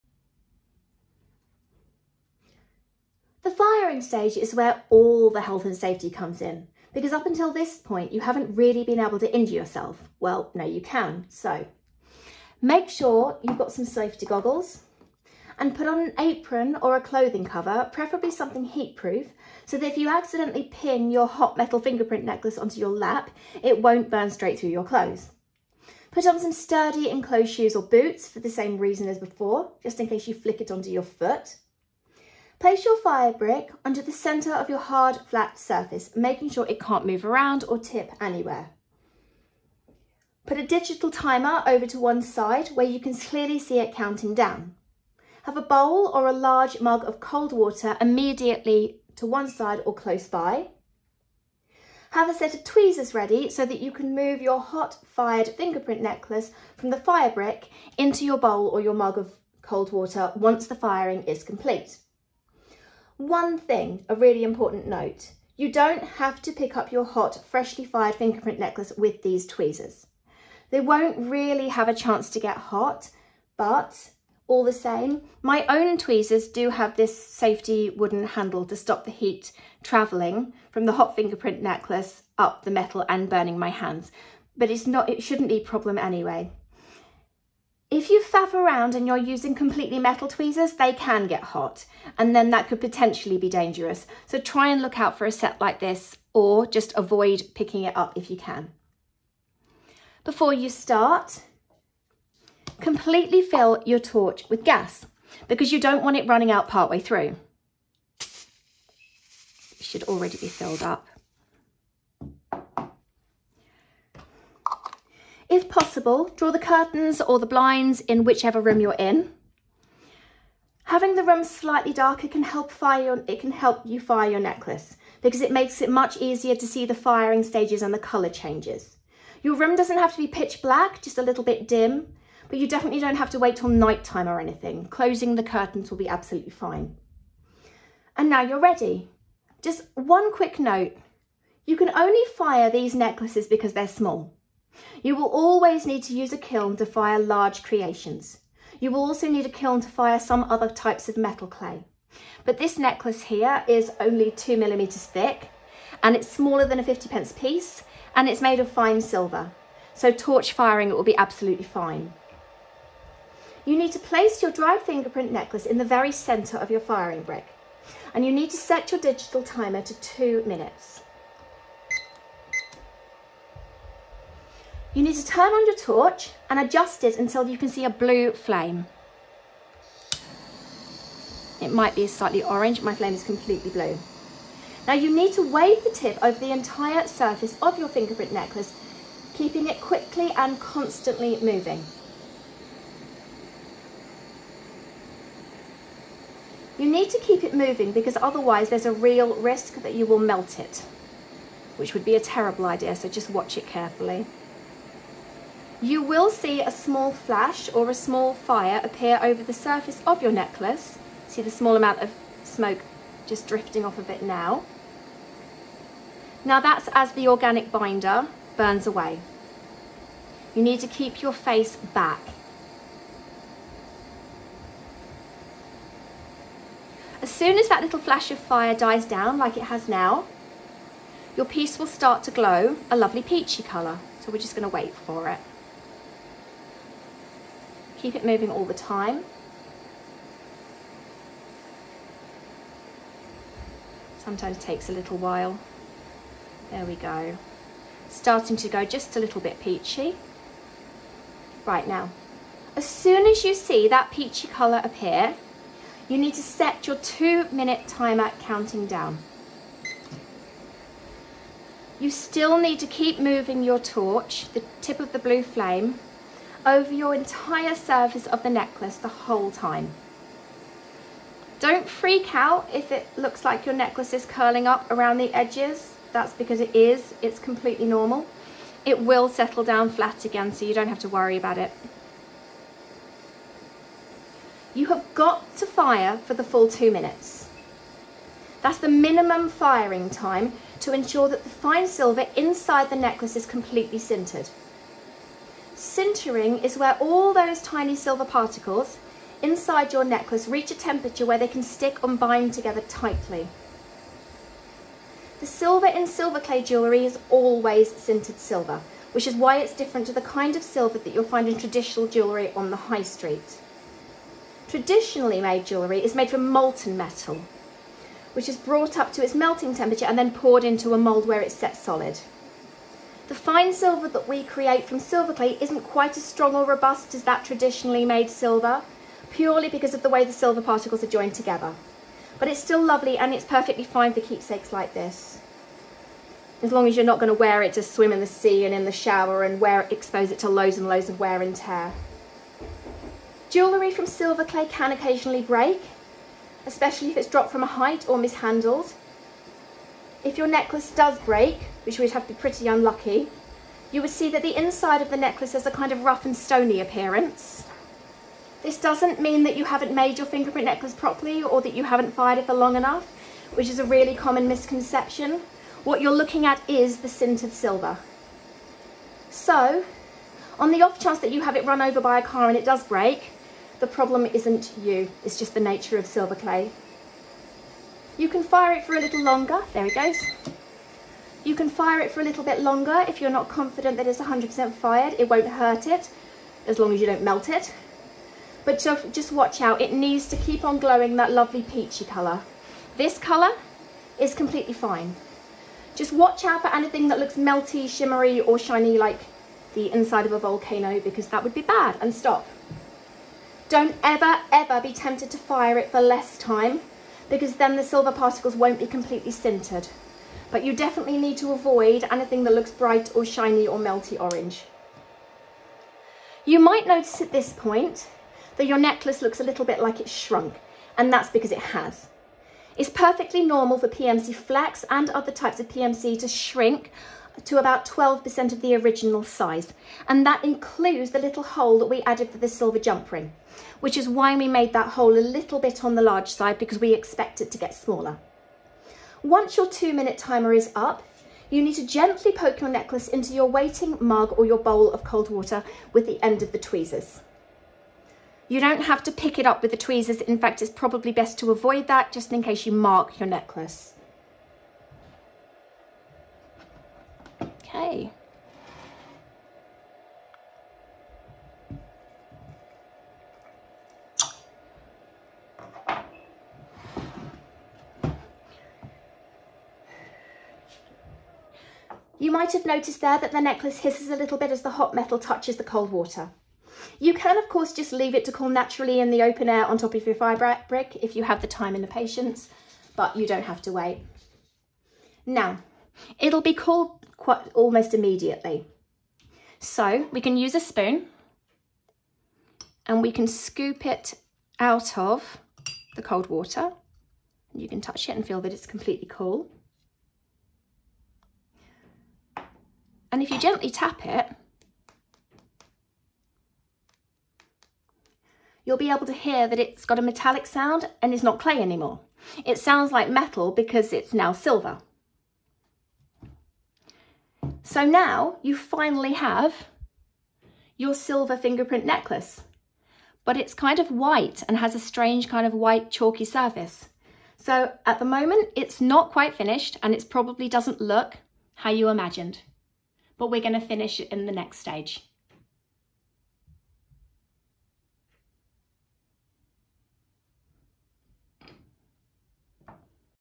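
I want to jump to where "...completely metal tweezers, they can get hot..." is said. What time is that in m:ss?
1:29.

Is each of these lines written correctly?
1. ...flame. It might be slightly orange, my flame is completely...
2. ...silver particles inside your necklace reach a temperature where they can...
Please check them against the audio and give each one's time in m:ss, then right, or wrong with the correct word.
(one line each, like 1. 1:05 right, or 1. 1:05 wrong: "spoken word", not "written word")
1. 2:58 right
2. 4:57 right.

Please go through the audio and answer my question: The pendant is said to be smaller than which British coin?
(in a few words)
50 pence piece.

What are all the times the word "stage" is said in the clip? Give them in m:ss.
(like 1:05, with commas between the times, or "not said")
0:03, 2:07, 8:54.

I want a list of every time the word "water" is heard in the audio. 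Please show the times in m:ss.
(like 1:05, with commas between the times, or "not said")
0:47, 0:59, 7:25, 7:55, 8:16.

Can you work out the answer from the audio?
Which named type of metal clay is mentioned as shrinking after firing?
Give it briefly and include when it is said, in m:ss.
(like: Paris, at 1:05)
PMC flex, at 7:03.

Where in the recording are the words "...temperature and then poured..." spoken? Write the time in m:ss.
5:19.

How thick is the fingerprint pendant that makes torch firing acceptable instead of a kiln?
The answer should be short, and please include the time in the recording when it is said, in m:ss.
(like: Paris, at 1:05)
2 millimeters, at 2:34.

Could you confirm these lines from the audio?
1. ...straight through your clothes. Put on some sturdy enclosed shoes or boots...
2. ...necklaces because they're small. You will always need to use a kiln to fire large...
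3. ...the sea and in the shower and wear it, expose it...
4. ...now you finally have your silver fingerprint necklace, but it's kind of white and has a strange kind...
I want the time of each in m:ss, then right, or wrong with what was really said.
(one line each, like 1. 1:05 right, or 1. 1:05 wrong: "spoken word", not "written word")
1. 0:24 right
2. 2:22 right
3. 5:38 right
4. 8:37 right.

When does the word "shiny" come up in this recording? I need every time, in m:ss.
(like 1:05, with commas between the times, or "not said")
6:38, 6:53.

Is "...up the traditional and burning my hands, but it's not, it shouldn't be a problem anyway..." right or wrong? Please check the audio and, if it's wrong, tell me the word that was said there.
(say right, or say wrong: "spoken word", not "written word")
wrong: "metal", not "traditional".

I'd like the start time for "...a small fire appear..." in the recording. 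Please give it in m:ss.
3:27.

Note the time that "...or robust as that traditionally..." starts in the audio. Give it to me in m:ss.
5:26.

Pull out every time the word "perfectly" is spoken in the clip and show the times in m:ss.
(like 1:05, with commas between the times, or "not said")
5:33, 7:02.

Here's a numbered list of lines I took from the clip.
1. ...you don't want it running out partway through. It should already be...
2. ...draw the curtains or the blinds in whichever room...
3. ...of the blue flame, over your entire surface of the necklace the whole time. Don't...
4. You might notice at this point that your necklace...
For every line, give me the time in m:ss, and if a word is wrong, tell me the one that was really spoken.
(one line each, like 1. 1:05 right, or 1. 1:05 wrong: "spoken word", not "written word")
1. 1:45 right
2. 1:56 right
3. 4:24 right
4. 6:56 right.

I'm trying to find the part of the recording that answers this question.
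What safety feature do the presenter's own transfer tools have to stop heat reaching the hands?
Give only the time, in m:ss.
1:17.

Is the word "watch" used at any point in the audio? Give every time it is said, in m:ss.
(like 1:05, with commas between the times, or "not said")
3:23, 6:29, 6:36.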